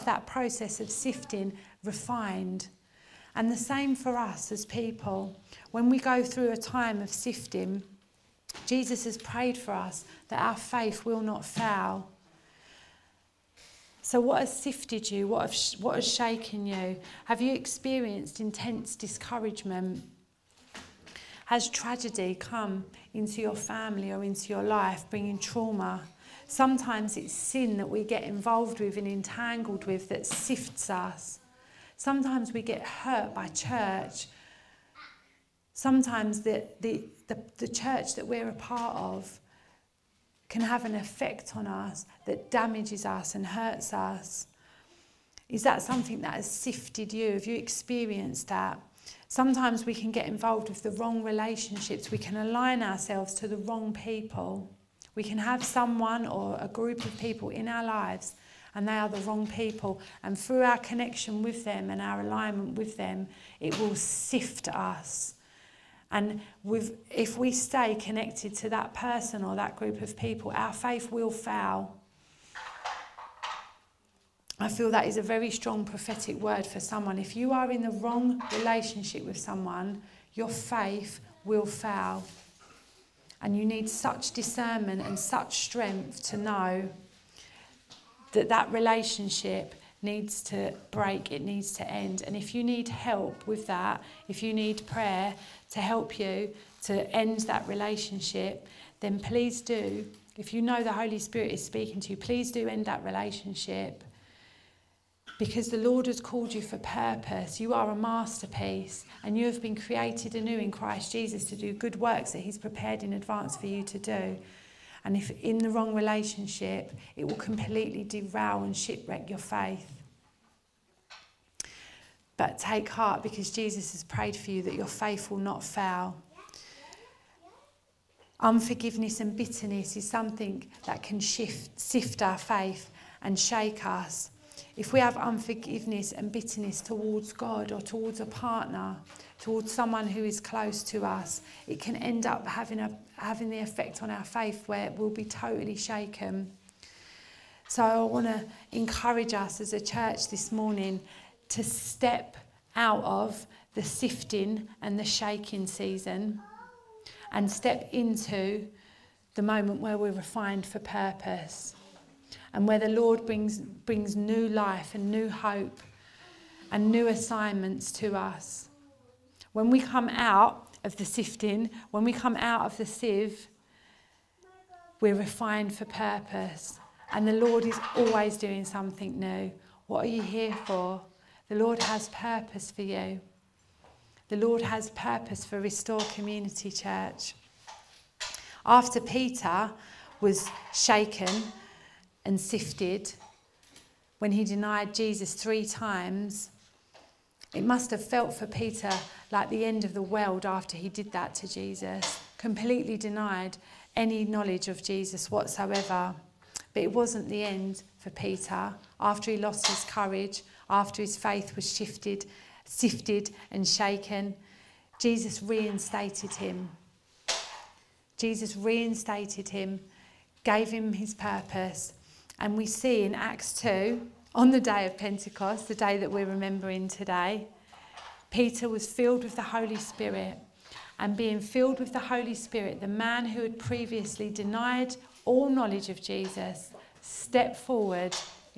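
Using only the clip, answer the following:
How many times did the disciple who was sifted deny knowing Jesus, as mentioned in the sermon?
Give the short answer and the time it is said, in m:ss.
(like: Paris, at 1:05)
3, at 3:15.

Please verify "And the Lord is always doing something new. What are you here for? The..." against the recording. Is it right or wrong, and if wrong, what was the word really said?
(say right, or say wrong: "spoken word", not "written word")
right.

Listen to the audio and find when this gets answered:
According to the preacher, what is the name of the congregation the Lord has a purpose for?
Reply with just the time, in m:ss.
3:05.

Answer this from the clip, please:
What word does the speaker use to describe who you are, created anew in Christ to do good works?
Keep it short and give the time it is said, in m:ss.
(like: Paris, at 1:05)
masterpiece, at 1:47.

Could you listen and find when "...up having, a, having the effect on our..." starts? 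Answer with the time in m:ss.
2:22.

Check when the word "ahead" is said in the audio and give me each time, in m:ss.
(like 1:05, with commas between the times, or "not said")
not said.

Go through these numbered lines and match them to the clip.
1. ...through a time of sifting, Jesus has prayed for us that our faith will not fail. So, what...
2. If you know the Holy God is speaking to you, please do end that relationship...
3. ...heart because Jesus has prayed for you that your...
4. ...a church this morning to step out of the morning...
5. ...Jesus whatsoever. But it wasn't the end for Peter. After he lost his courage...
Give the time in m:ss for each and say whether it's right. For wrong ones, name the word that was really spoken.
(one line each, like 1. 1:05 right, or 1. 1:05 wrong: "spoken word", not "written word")
1. 0:06 right
2. 1:40 wrong: "Spirit", not "God"
3. 2:02 right
4. 2:29 wrong: "sifting", not "morning"
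5. 3:24 right.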